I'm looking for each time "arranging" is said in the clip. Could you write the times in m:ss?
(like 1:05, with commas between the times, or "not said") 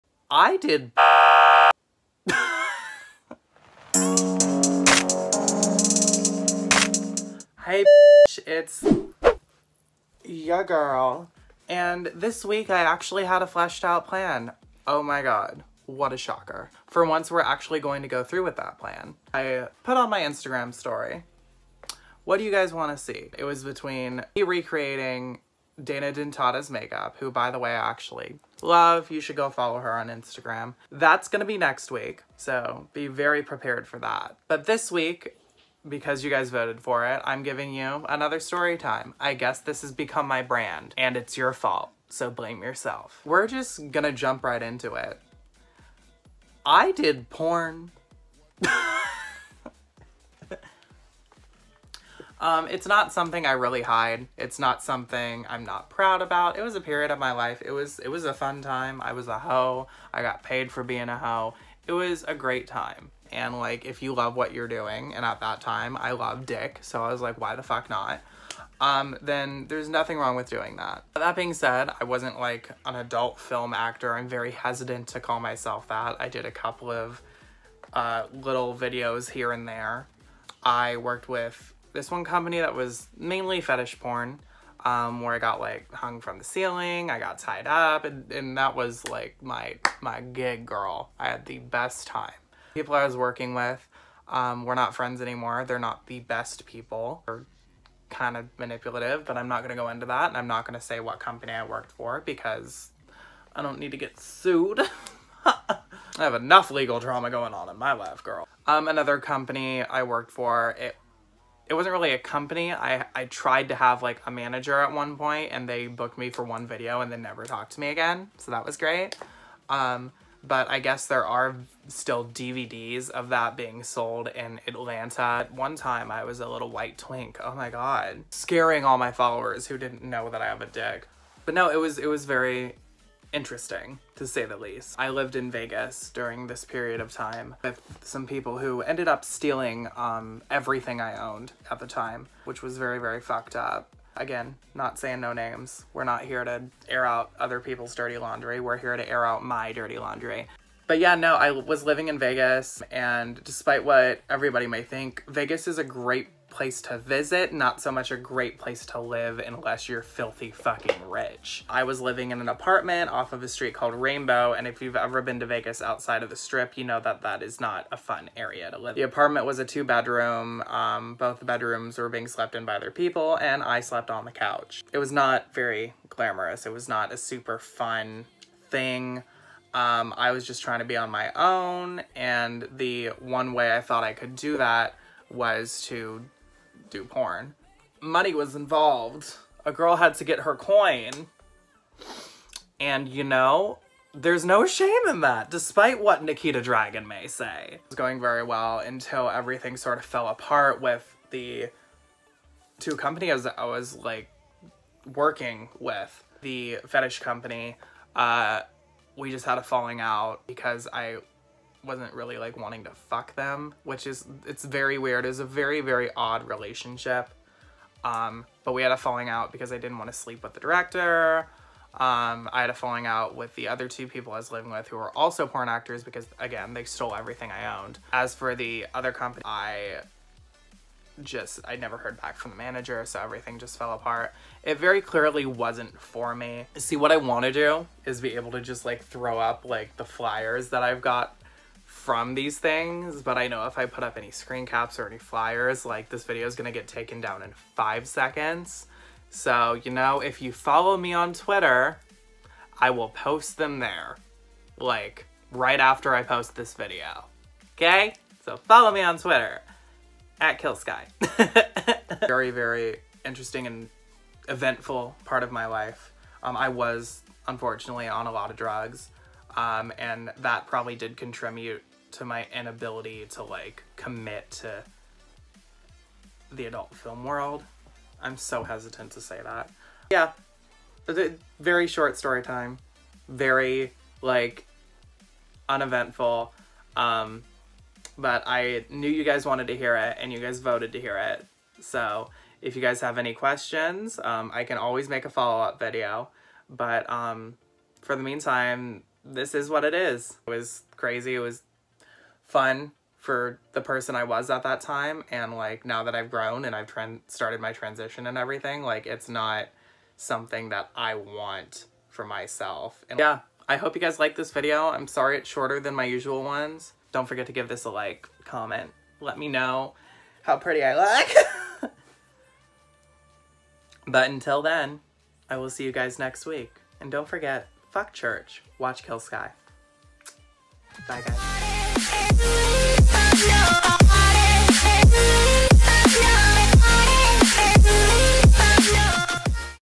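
not said.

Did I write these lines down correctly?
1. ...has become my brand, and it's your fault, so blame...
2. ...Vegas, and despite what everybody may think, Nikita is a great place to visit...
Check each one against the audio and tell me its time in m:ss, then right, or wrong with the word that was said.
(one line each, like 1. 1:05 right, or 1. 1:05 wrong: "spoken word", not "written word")
1. 0:39 right
2. 2:32 wrong: "Vegas", not "Nikita".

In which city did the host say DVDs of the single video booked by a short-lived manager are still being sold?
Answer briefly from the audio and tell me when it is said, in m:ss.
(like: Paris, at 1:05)
Atlanta, at 2:04.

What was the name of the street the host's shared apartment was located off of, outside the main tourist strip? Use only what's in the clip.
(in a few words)
Rainbow.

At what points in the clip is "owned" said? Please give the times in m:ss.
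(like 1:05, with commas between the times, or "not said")
2:21, 3:47.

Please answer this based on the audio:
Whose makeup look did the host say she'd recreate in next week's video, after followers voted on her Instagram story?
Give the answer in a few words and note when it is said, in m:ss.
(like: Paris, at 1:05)
Dana Dentata, at 0:25.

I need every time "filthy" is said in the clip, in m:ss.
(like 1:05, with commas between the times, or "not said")
2:40.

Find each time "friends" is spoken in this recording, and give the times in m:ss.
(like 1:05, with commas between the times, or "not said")
1:34.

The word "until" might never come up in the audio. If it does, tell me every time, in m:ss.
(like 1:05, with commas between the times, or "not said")
3:18, 5:24.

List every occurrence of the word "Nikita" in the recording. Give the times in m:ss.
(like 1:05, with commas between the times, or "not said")
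3:16.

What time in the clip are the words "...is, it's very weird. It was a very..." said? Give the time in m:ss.
3:34.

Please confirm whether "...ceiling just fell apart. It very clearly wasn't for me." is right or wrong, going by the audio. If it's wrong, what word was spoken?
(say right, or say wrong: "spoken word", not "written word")
wrong: "everything", not "ceiling".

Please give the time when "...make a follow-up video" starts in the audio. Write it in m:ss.
4:55.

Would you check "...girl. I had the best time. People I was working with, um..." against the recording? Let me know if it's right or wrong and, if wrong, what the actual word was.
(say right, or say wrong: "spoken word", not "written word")
right.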